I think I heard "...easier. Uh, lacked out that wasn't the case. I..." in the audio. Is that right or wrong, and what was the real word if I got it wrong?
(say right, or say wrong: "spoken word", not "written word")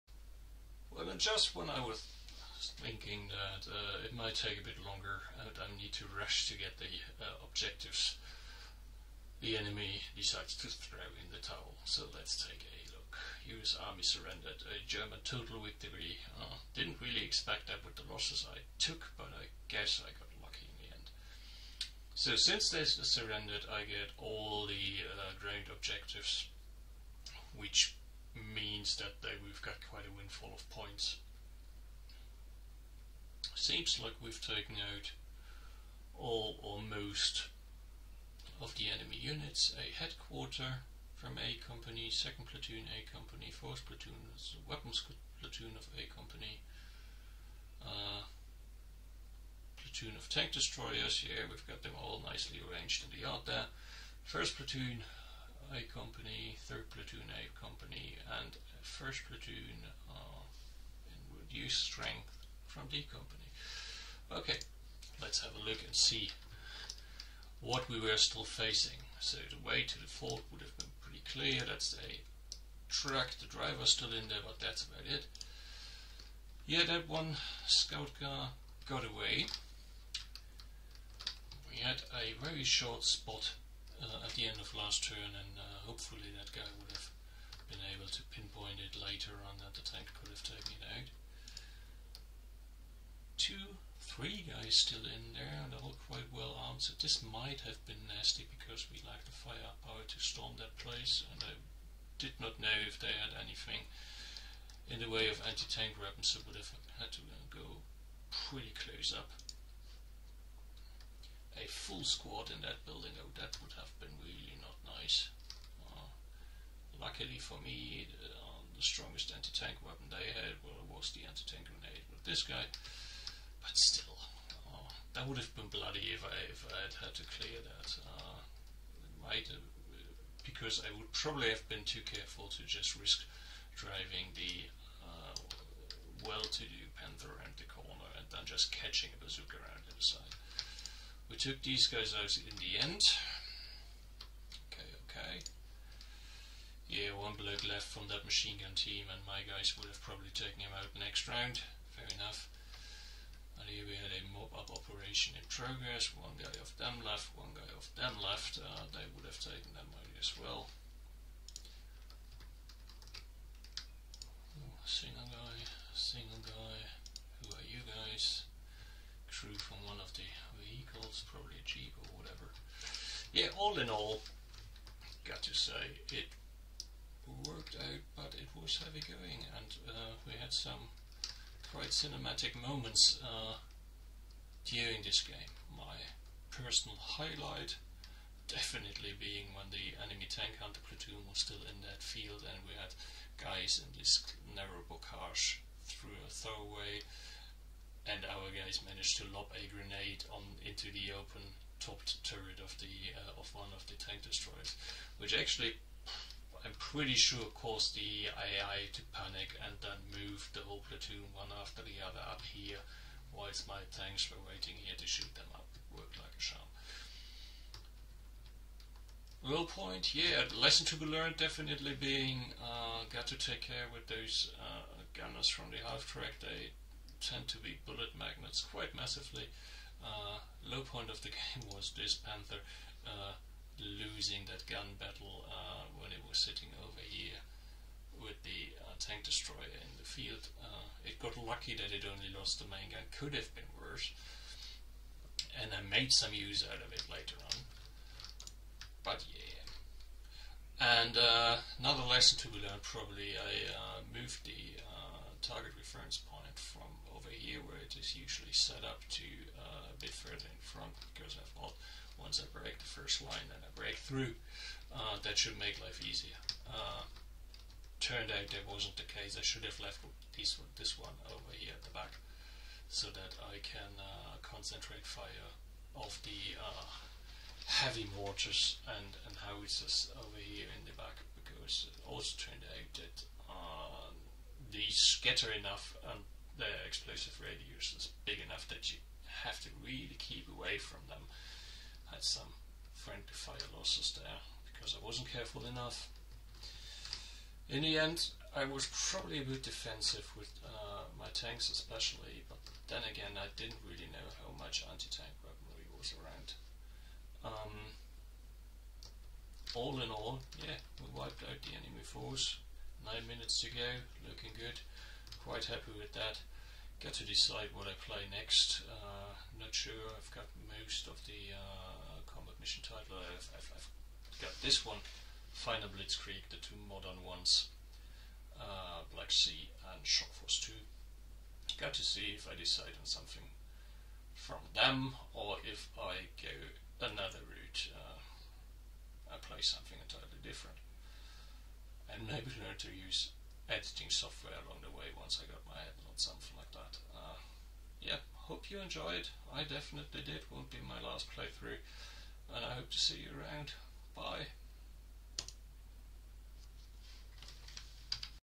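wrong: "turned", not "lacked".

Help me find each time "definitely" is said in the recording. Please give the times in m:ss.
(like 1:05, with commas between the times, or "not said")
3:08, 3:41, 5:49.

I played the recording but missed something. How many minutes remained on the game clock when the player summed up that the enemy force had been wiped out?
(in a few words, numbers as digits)
9.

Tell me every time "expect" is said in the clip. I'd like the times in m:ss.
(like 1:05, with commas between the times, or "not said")
0:17.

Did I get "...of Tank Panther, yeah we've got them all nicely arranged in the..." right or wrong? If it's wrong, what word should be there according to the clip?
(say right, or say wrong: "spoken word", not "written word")
wrong: "Destroyers", not "Panther".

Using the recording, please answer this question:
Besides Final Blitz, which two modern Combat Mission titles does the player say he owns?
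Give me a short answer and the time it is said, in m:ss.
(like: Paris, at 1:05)
Black Sea and Shock Force 2, at 5:29.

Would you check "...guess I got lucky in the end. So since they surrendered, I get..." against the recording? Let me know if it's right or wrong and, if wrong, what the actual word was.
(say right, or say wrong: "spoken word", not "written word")
right.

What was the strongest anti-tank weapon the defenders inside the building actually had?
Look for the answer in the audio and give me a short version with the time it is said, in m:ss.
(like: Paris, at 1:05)
Anti-tank grenade, at 2:01.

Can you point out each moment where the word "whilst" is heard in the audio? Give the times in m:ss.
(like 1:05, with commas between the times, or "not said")
3:33.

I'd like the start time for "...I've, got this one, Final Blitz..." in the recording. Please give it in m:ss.
5:23.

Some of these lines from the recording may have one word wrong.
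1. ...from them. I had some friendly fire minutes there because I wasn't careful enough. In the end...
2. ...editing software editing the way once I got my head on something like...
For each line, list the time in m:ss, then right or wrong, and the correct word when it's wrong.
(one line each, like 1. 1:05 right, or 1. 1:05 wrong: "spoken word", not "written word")
1. 4:50 wrong: "losses", not "minutes"
2. 5:43 wrong: "along", not "editing".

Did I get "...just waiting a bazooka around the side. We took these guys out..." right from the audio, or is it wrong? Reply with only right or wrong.
wrong.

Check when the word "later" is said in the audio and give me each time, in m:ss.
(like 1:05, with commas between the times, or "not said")
1:28, 4:07.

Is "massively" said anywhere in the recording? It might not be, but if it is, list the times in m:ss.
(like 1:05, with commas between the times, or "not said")
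3:48.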